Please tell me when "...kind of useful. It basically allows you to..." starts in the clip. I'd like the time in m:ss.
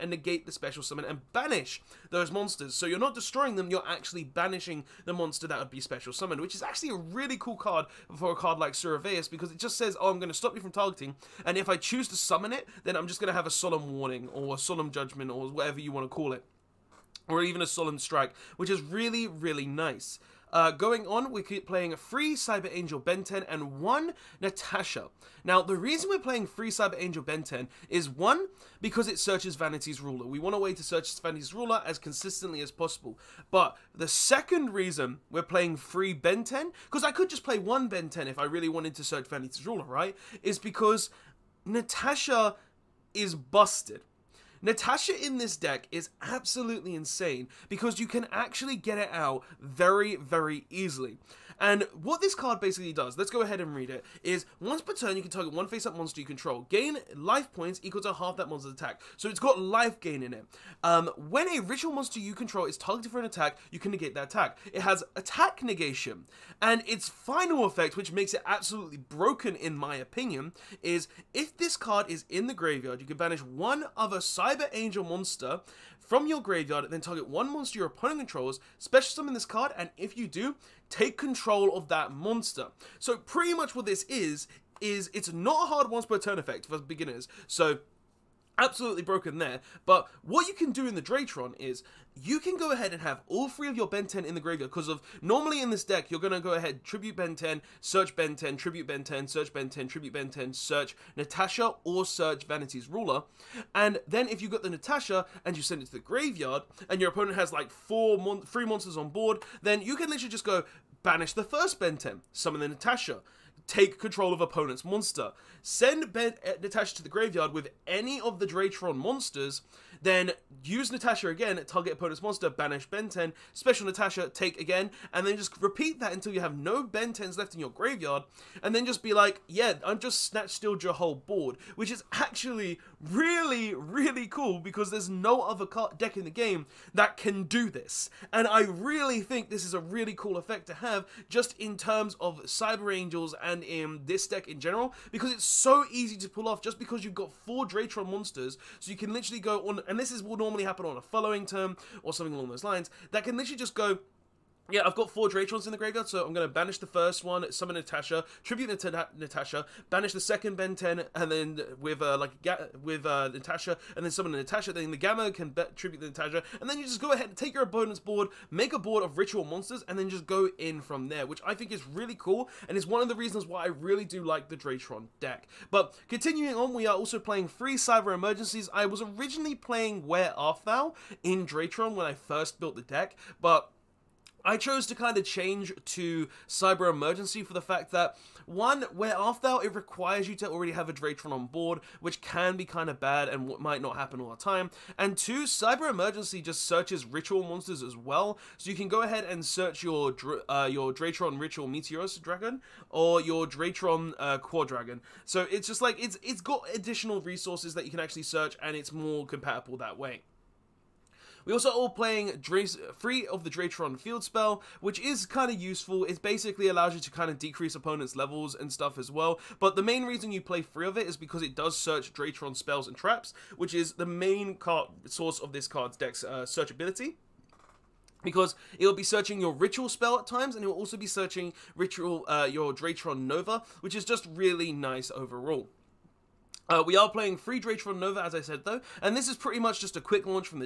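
3:35.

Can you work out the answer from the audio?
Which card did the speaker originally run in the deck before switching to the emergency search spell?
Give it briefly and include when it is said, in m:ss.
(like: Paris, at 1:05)
Where Art Thou, at 3:00.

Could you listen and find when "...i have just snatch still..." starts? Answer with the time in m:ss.
2:09.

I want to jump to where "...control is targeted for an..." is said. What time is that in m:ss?
1:02.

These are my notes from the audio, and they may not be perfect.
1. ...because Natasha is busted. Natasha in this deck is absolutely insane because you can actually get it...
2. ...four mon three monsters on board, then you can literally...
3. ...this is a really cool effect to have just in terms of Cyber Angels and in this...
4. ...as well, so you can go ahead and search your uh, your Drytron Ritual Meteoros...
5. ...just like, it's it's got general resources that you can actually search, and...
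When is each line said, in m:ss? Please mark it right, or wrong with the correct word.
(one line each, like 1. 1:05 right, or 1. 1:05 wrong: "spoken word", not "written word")
1. 0:40 right
2. 1:47 right
3. 2:19 right
4. 3:17 right
5. 3:25 wrong: "additional", not "general".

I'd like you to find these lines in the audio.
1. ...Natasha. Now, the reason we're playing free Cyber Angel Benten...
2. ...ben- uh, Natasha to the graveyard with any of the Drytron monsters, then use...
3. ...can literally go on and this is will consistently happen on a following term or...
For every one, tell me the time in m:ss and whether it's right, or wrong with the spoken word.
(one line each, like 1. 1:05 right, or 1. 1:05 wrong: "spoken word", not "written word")
1. 0:24 right
2. 1:56 right
3. 2:28 wrong: "normally", not "consistently".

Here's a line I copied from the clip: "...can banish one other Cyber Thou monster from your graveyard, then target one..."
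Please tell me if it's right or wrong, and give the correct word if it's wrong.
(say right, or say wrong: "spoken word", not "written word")
wrong: "Angel", not "Thou".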